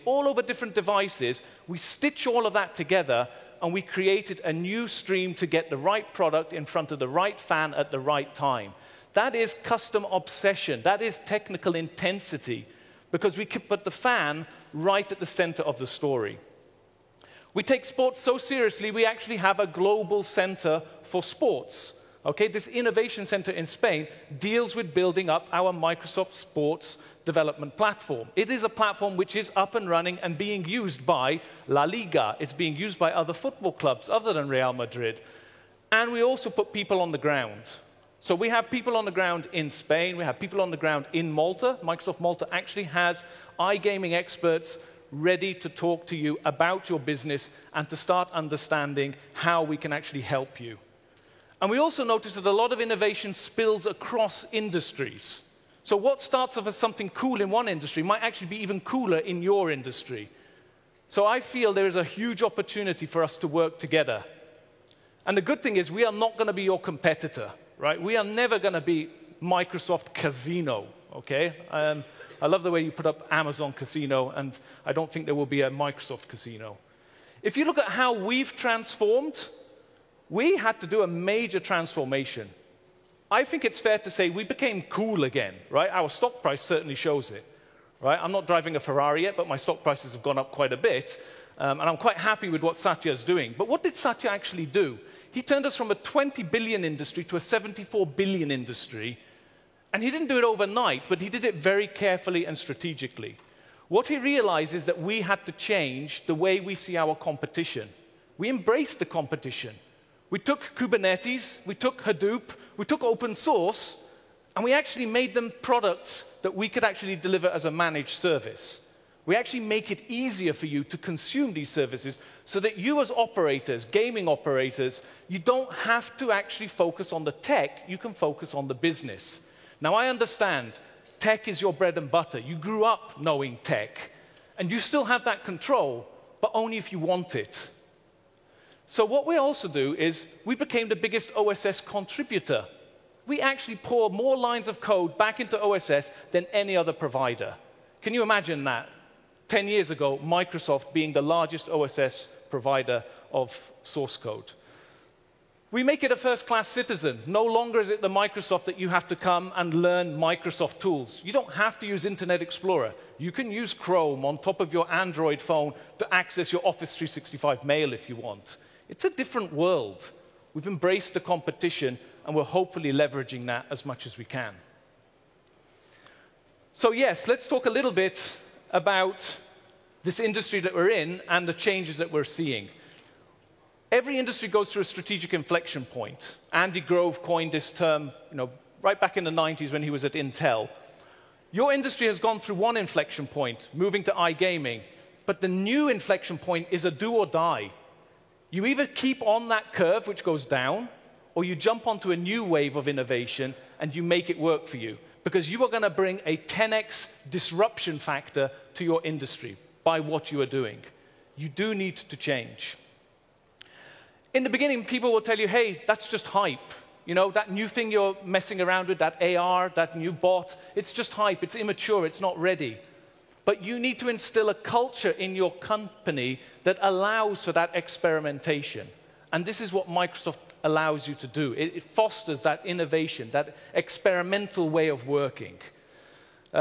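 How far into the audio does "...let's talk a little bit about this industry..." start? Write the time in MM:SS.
02:57.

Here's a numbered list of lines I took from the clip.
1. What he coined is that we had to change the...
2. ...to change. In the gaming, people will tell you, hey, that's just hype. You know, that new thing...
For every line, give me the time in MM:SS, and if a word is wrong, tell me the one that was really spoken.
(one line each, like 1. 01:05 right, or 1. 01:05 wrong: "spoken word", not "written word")
1. 01:43 wrong: "realized", not "coined"
2. 03:31 wrong: "beginning", not "gaming".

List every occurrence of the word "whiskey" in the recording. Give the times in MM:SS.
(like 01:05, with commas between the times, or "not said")
not said.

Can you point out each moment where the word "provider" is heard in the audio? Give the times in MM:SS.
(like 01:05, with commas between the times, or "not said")
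02:26, 02:32.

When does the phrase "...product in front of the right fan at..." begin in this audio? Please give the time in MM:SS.
00:06.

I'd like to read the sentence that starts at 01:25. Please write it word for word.
Our stock price certainly shows it, right?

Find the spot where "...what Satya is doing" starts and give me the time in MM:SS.
01:32.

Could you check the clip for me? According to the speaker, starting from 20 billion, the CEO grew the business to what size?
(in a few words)
74 billion.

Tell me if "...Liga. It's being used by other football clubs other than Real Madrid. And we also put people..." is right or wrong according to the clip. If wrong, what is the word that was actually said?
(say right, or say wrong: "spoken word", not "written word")
right.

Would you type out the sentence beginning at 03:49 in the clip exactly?
And this is what Microsoft allows you to do.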